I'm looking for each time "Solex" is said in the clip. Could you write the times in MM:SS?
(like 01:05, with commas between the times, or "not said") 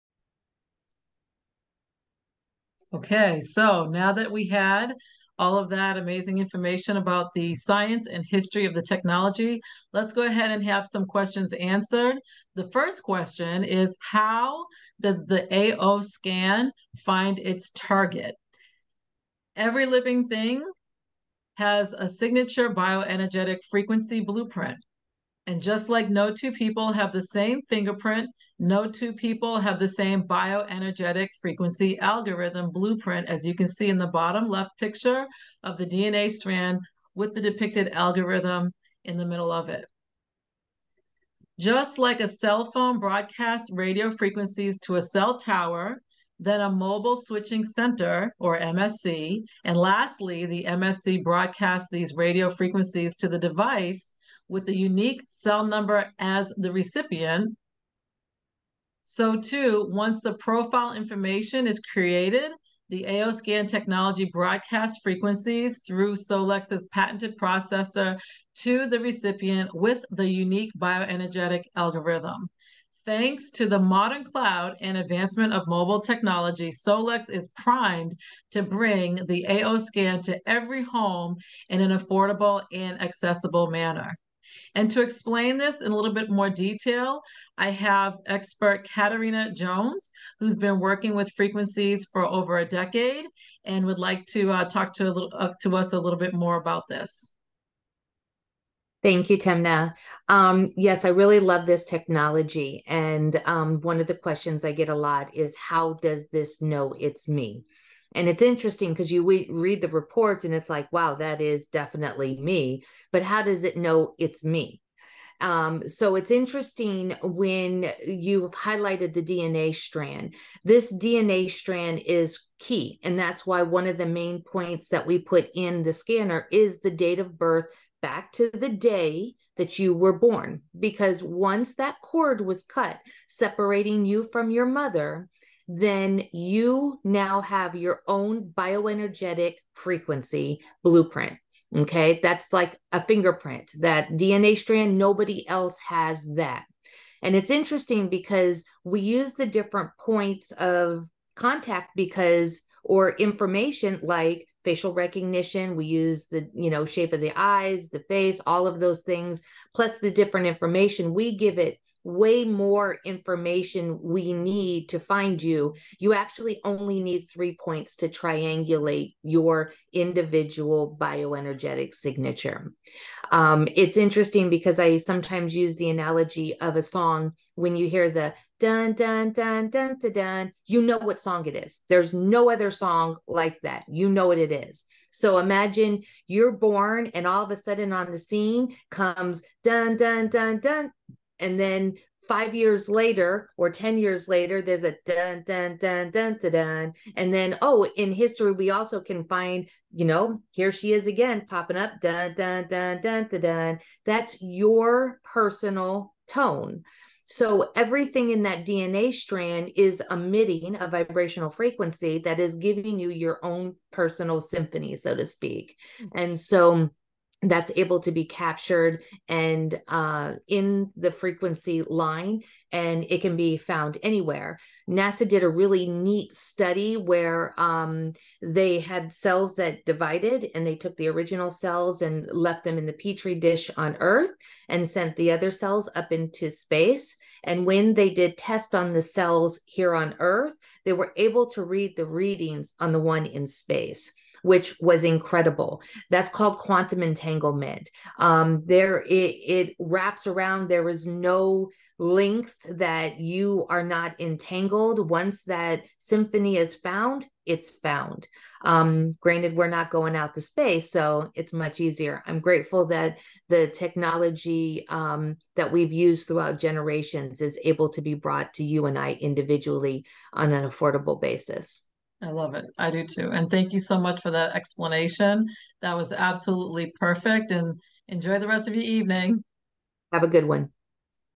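01:06, 01:16.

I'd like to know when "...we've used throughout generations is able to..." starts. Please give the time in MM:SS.
04:25.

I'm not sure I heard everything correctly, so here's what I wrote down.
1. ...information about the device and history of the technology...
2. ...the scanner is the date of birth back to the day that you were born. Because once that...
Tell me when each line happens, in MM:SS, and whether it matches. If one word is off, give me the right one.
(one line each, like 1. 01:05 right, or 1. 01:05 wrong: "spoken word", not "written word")
1. 00:06 wrong: "science", not "device"
2. 02:05 right.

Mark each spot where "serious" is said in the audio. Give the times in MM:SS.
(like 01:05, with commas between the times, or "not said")
not said.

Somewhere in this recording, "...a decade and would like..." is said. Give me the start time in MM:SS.
01:32.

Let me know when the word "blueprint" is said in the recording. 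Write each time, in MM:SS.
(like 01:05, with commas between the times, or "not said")
00:24, 00:32, 02:20.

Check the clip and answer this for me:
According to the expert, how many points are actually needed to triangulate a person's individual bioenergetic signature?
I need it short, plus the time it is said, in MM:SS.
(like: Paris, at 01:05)
3, at 02:47.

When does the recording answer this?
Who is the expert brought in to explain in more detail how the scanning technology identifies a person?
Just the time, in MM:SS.
01:28.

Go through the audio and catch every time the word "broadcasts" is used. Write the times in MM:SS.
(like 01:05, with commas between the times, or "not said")
00:42, 00:51, 01:04.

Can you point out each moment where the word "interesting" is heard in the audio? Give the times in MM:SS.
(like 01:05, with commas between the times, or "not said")
01:48, 01:56, 02:27, 02:53.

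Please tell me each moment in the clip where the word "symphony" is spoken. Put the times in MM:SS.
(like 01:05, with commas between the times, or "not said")
03:34, 04:15.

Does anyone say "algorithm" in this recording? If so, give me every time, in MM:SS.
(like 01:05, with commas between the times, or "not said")
00:31, 00:37, 01:11.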